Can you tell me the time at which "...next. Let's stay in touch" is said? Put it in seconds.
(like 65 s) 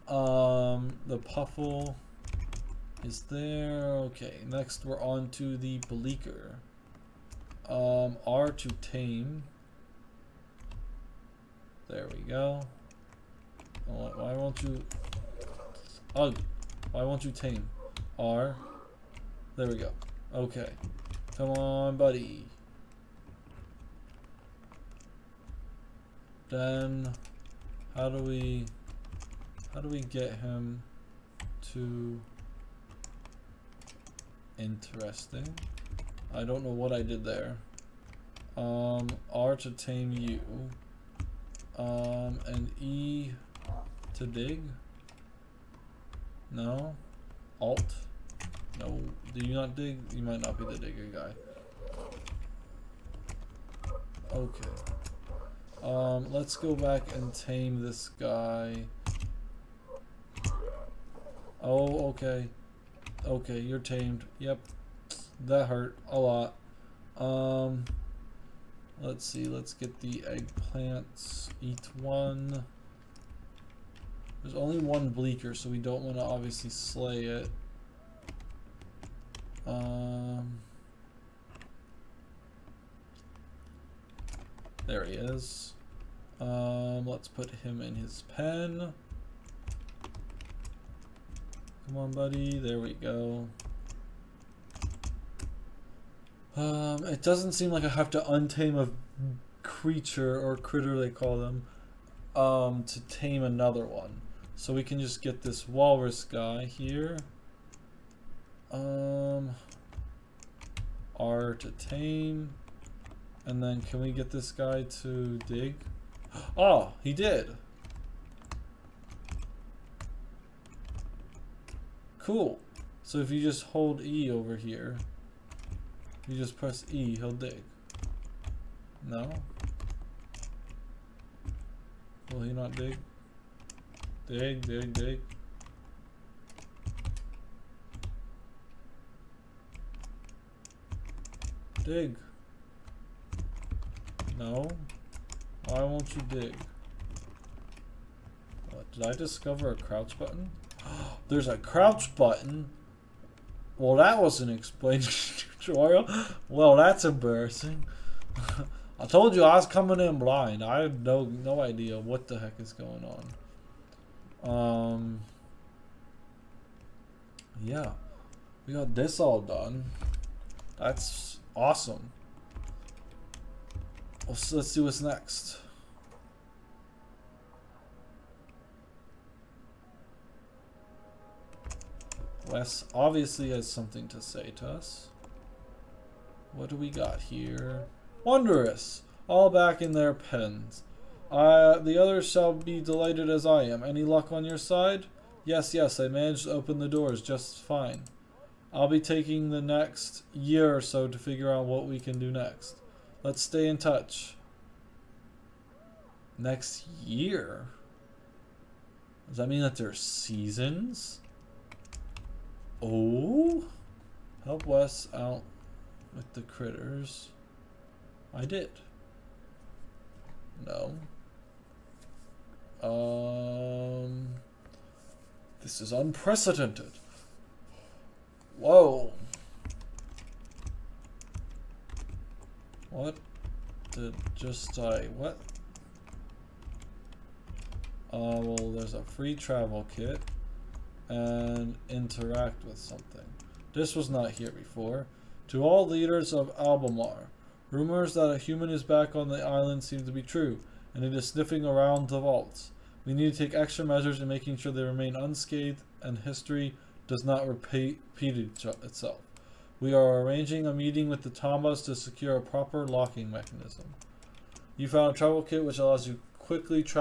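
202 s.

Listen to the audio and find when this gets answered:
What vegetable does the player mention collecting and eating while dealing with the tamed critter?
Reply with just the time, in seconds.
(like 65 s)
70 s.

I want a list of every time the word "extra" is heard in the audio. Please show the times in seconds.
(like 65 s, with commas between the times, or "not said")
253 s.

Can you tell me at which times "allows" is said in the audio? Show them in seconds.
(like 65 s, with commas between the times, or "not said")
265 s.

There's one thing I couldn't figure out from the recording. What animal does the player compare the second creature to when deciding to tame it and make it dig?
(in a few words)
Walrus.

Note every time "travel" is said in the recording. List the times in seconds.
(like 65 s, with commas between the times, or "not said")
239 s, 265 s.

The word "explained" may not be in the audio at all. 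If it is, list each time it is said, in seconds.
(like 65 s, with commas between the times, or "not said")
154 s.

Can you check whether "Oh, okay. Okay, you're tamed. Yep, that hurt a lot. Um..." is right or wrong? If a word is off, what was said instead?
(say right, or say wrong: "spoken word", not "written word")
right.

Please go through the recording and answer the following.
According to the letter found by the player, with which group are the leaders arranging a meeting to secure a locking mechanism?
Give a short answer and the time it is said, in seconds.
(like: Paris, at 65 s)
The Tombas, at 261 s.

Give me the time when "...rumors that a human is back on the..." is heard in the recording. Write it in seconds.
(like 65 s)
247 s.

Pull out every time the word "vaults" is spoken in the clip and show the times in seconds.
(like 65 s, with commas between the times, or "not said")
252 s.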